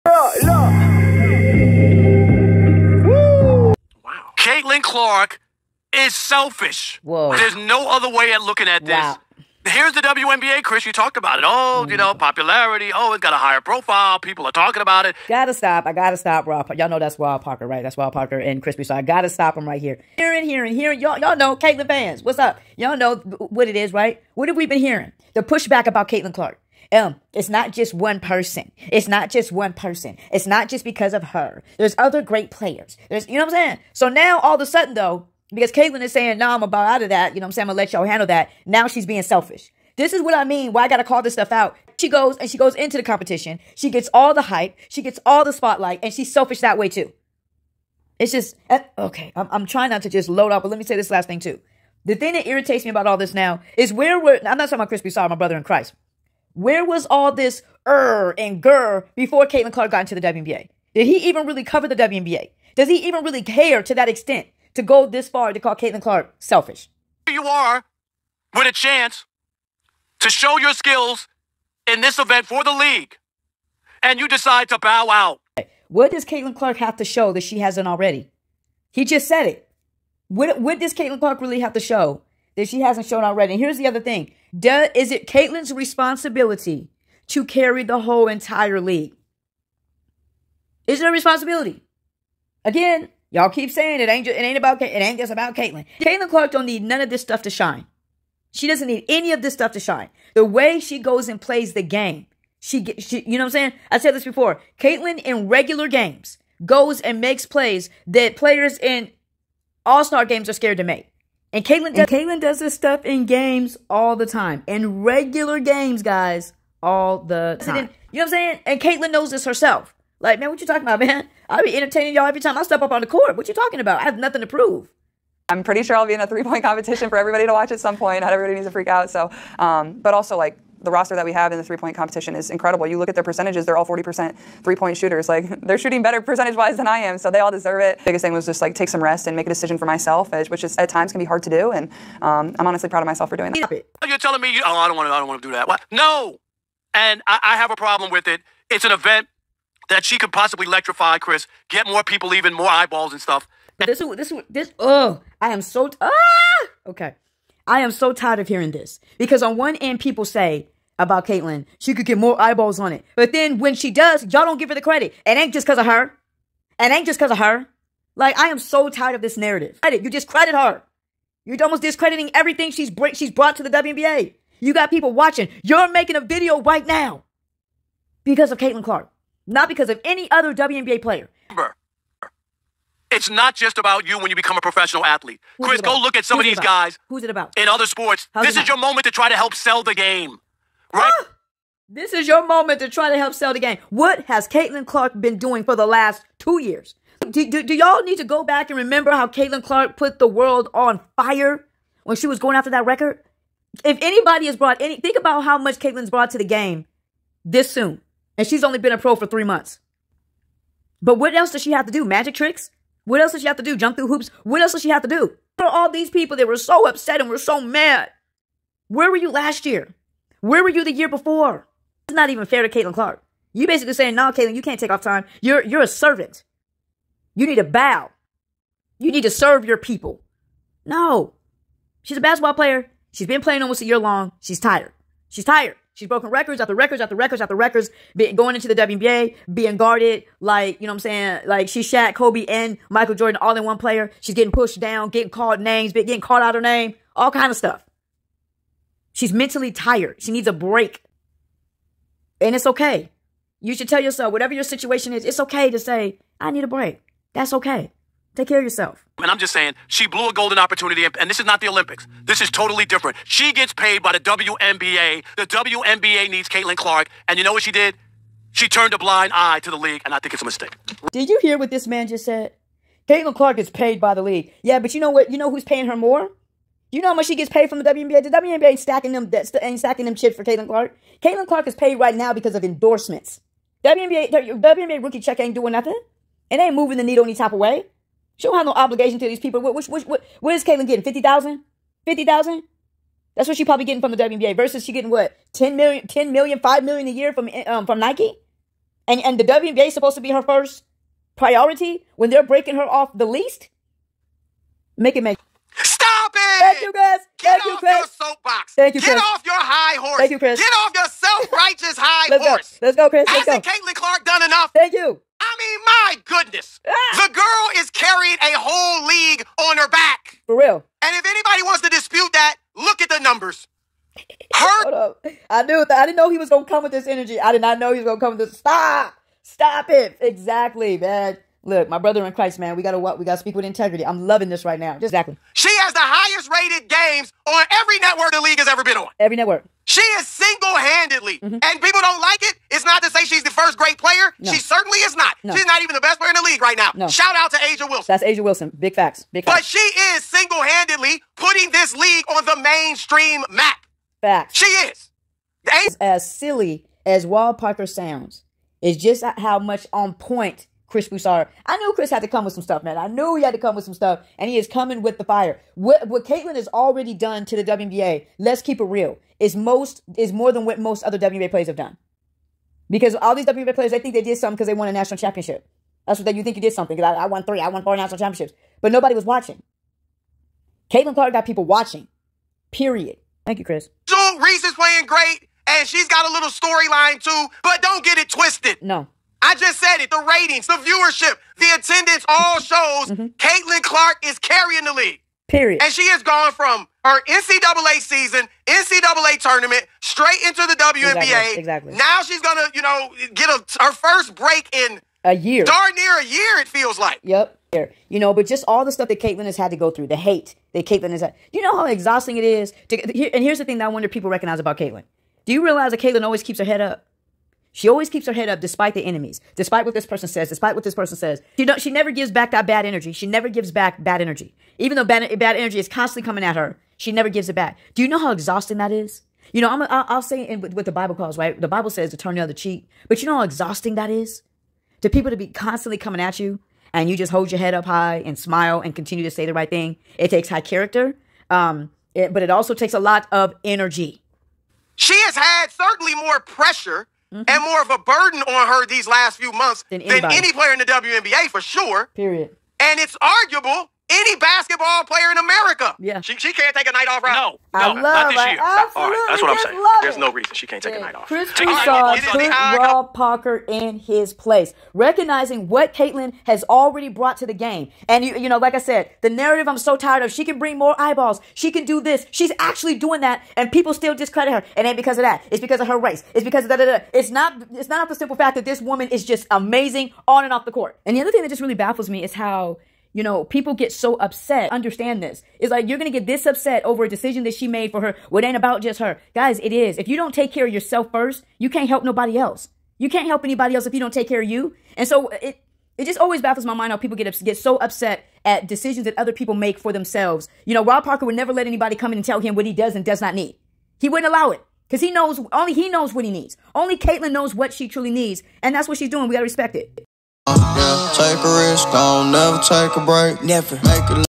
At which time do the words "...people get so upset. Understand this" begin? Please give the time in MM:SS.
08:03.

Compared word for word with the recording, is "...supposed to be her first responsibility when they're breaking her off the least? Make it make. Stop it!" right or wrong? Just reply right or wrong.
wrong.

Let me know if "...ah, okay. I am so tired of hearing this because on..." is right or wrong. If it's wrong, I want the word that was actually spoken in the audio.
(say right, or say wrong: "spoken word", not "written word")
right.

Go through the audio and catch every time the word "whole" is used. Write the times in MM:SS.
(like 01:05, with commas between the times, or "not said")
01:28, 05:18.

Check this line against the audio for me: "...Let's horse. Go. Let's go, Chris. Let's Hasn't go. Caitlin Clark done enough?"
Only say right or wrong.
right.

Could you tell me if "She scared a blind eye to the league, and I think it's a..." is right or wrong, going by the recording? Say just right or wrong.
wrong.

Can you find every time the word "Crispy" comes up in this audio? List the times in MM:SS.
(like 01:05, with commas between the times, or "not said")
00:18, 00:54.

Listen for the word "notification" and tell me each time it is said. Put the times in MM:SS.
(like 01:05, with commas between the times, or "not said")
not said.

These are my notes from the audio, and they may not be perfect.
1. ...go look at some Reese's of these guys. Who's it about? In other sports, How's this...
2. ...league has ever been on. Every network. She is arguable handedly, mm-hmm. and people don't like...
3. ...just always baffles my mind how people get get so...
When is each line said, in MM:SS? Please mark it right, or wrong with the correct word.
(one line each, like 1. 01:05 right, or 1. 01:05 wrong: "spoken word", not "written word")
1. 03:05 wrong: "Who", not "Reese"
2. 05:38 wrong: "single", not "arguable"
3. 08:16 right.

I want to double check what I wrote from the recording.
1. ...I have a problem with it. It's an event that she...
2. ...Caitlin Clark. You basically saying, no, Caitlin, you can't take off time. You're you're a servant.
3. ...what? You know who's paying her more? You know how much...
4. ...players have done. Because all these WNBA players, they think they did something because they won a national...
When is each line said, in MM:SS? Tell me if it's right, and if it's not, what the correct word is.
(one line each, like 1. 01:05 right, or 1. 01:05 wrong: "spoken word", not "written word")
1. 02:27 right
2. 03:42 right
3. 04:35 right
4. 06:11 right.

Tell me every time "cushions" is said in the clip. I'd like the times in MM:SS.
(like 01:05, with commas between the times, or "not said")
not said.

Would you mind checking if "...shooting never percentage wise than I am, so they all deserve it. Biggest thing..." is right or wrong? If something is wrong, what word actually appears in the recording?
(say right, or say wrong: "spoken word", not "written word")
wrong: "better", not "never".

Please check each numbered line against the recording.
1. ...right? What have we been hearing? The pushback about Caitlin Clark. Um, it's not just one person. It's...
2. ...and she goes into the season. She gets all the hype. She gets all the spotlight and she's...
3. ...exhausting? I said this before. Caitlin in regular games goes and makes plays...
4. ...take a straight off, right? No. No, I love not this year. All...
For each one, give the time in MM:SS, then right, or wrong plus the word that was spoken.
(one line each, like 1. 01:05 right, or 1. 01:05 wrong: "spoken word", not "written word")
1. 00:23 right
2. 00:42 wrong: "competition", not "season"
3. 01:43 wrong: "saying", not "exhausting"
4. 07:36 wrong: "night", not "straight".